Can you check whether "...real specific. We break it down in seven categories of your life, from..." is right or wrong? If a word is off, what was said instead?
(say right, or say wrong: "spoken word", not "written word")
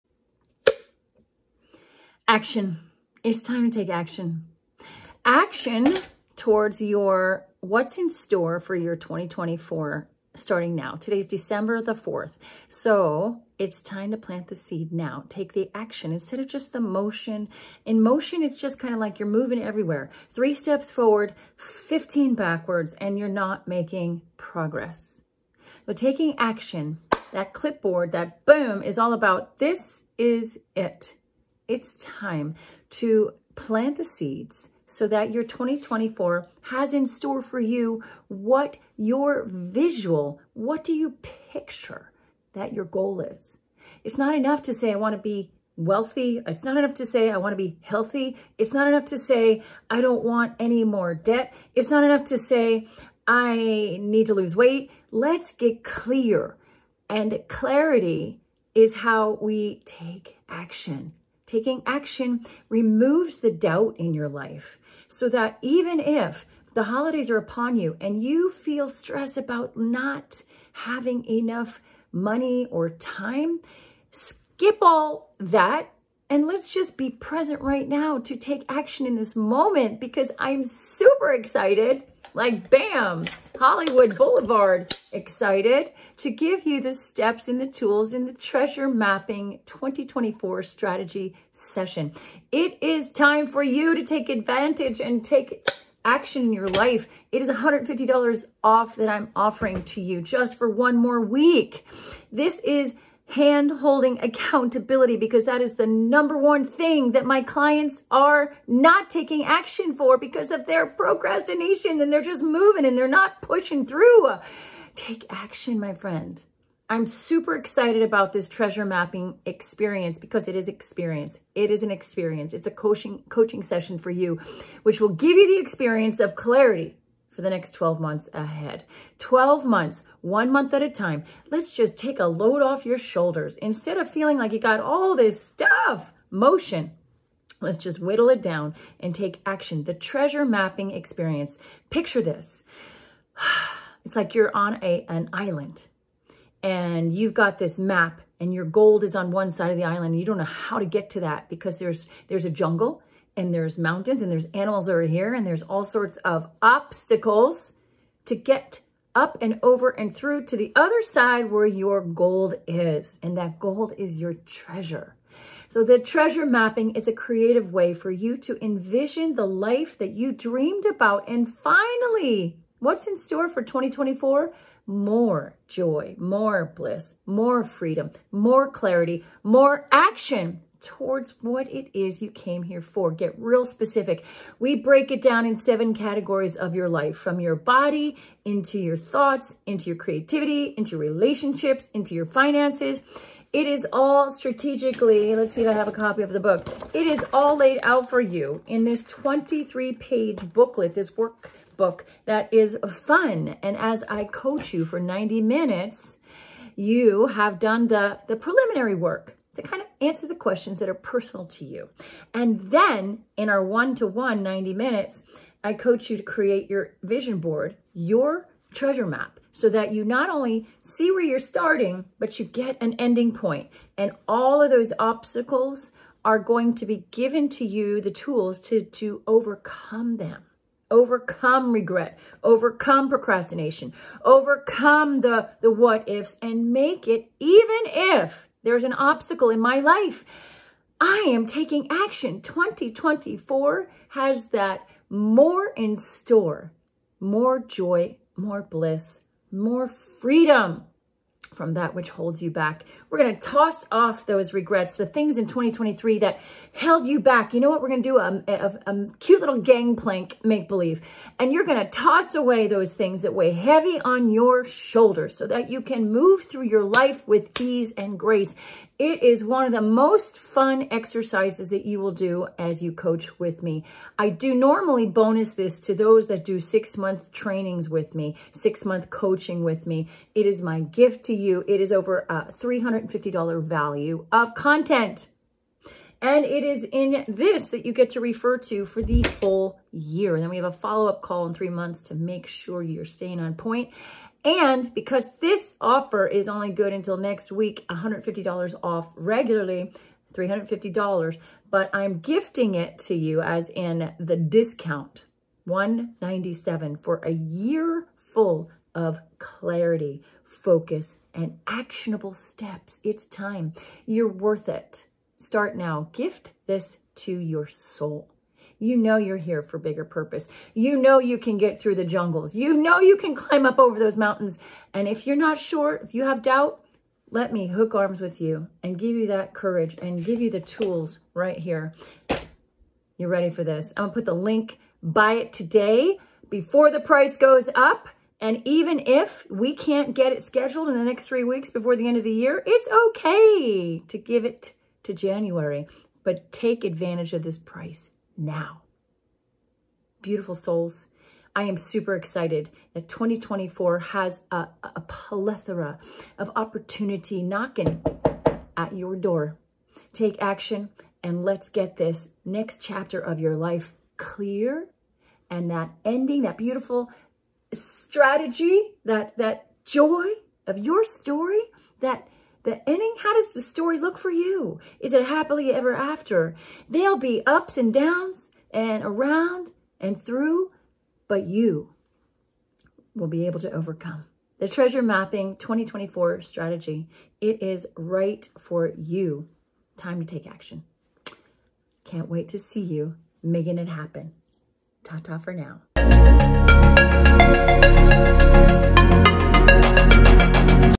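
right.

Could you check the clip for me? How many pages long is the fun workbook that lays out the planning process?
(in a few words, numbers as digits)
23.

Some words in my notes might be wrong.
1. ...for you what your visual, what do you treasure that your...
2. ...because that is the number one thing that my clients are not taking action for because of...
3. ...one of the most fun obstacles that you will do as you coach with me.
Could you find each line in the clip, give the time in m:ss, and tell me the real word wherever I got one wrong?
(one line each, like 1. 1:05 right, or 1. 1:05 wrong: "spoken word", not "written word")
1. 0:37 wrong: "picture", not "treasure"
2. 1:45 right
3. 4:29 wrong: "exercises", not "obstacles".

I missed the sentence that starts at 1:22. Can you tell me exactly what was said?
Like, bam, Hollywood Boulevard excited to give you the steps and the tools in the Treasure Mapping 2024 strategy session.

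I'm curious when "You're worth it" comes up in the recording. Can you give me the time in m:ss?
5:14.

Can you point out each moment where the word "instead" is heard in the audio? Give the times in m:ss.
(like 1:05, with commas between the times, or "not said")
0:16, 2:13.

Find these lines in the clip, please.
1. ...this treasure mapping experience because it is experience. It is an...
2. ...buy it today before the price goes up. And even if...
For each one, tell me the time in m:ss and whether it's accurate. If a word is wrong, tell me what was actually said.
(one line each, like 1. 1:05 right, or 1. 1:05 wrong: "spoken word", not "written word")
1. 1:58 right
2. 5:35 right.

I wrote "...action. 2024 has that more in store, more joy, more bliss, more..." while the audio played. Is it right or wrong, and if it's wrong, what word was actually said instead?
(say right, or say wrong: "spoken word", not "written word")
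right.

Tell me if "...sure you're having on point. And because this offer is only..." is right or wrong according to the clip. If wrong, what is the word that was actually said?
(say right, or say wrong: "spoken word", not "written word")
wrong: "staying", not "having".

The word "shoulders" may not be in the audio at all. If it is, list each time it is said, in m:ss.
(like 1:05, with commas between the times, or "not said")
2:12, 4:24.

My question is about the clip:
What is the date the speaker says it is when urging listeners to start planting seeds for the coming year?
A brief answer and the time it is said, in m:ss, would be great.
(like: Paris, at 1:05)
December 4th, at 0:11.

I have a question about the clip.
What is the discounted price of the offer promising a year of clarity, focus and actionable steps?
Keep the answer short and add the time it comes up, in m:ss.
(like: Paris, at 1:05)
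197, at 5:05.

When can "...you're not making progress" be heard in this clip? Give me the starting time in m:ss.
0:23.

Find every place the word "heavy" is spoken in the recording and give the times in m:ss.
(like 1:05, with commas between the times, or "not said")
4:23.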